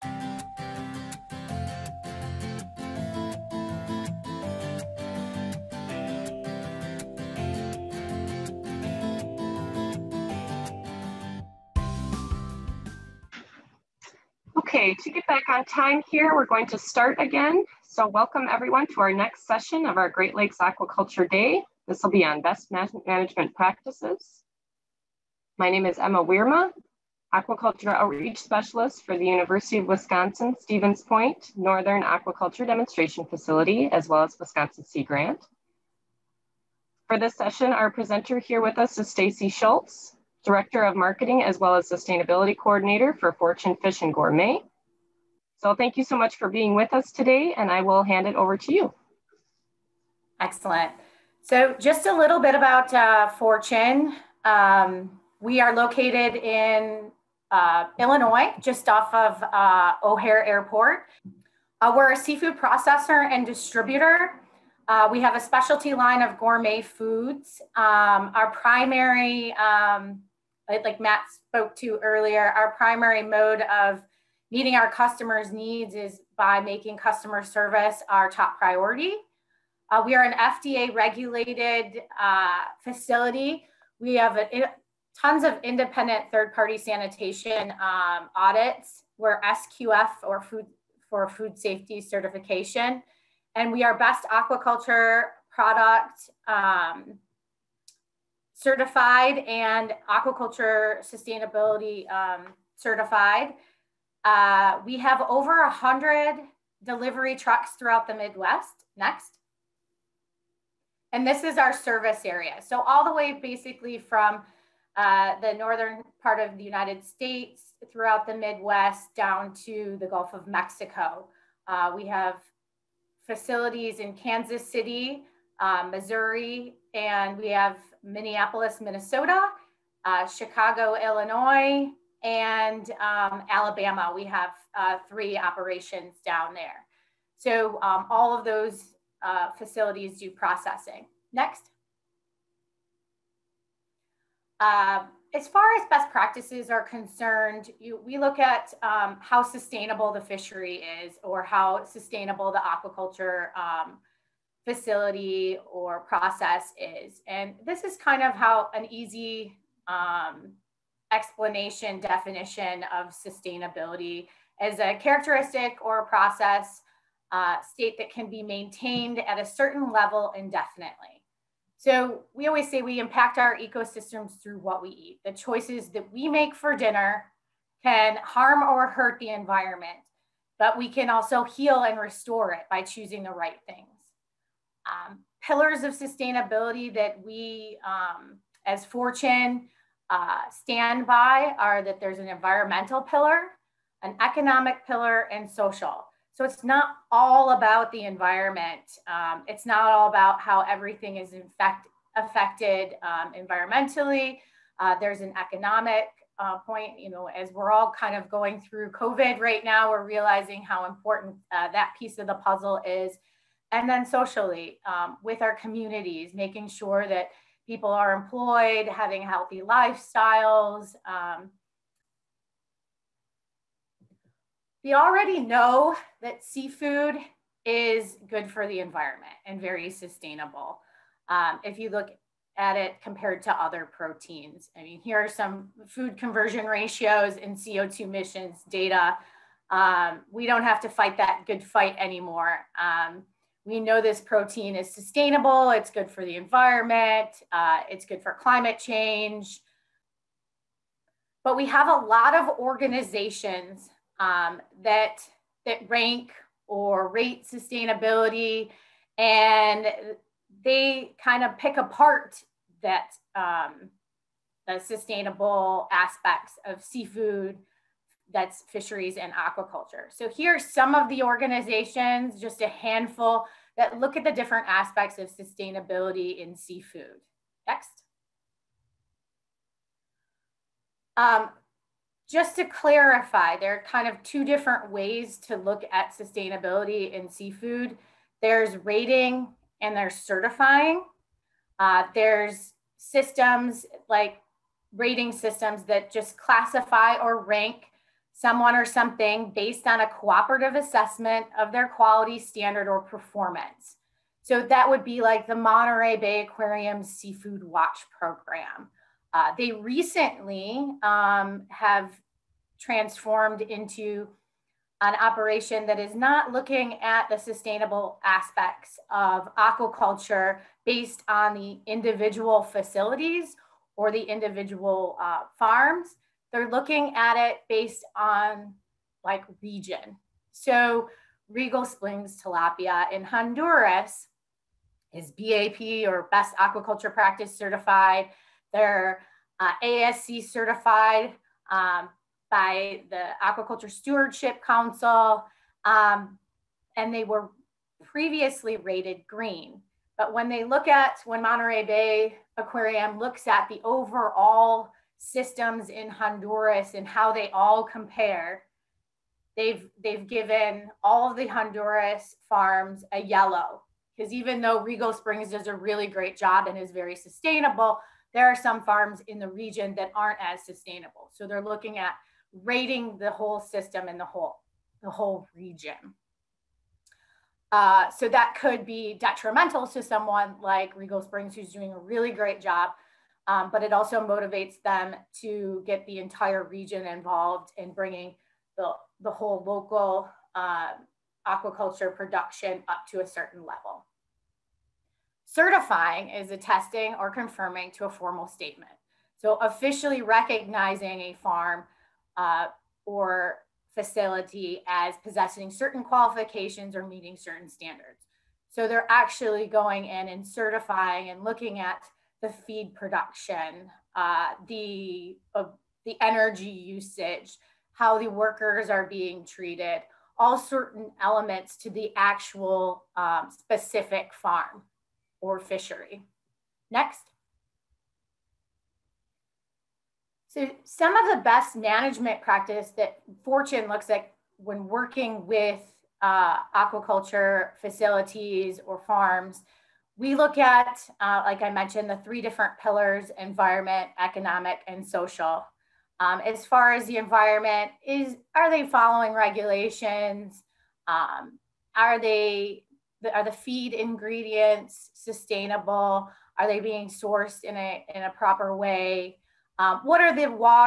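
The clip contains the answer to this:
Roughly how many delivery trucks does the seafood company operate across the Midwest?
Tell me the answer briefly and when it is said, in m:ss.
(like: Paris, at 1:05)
over 100, at 1:45.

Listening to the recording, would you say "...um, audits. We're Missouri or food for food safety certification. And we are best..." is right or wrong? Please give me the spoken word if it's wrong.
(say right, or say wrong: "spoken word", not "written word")
wrong: "SQF", not "Missouri".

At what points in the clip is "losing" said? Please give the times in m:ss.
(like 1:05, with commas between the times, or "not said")
not said.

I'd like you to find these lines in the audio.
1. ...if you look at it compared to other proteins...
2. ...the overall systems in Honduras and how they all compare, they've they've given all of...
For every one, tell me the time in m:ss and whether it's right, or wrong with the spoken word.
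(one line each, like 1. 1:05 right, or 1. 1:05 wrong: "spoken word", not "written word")
1. 3:51 right
2. 5:53 right.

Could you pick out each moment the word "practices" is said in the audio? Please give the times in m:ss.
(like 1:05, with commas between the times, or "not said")
0:23, 2:26, 5:37, 7:12.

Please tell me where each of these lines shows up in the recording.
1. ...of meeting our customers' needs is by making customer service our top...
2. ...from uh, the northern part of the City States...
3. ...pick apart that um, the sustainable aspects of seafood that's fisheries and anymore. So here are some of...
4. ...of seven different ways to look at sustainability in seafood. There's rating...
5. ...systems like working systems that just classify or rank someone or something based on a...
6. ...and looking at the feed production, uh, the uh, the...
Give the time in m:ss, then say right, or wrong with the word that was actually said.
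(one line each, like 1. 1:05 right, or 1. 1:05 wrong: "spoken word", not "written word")
1. 1:13 right
2. 1:53 wrong: "United", not "City"
3. 4:21 wrong: "aquaculture", not "anymore"
4. 4:44 wrong: "two", not "seven"
5. 4:52 wrong: "rating", not "working"
6. 6:51 right.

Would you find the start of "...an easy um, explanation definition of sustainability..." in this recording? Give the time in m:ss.
2:38.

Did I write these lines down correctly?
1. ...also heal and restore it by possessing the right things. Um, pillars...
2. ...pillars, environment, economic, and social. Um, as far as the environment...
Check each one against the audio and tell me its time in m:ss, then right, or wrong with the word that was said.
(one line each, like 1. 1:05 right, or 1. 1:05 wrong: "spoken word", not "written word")
1. 3:01 wrong: "choosing", not "possessing"
2. 7:22 right.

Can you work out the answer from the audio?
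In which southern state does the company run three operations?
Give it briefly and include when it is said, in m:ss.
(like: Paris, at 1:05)
Alabama, at 2:13.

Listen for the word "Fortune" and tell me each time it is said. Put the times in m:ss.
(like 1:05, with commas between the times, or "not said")
0:43, 0:53, 3:08, 7:13.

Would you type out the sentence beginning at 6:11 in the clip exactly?
So they're looking at rating the whole system and the whole the whole region.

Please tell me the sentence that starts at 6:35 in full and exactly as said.
Certifying is attesting or confirming to a formal statement.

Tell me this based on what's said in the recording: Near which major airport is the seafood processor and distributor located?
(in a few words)
O'Hare Airport.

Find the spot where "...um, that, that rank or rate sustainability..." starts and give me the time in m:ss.
4:14.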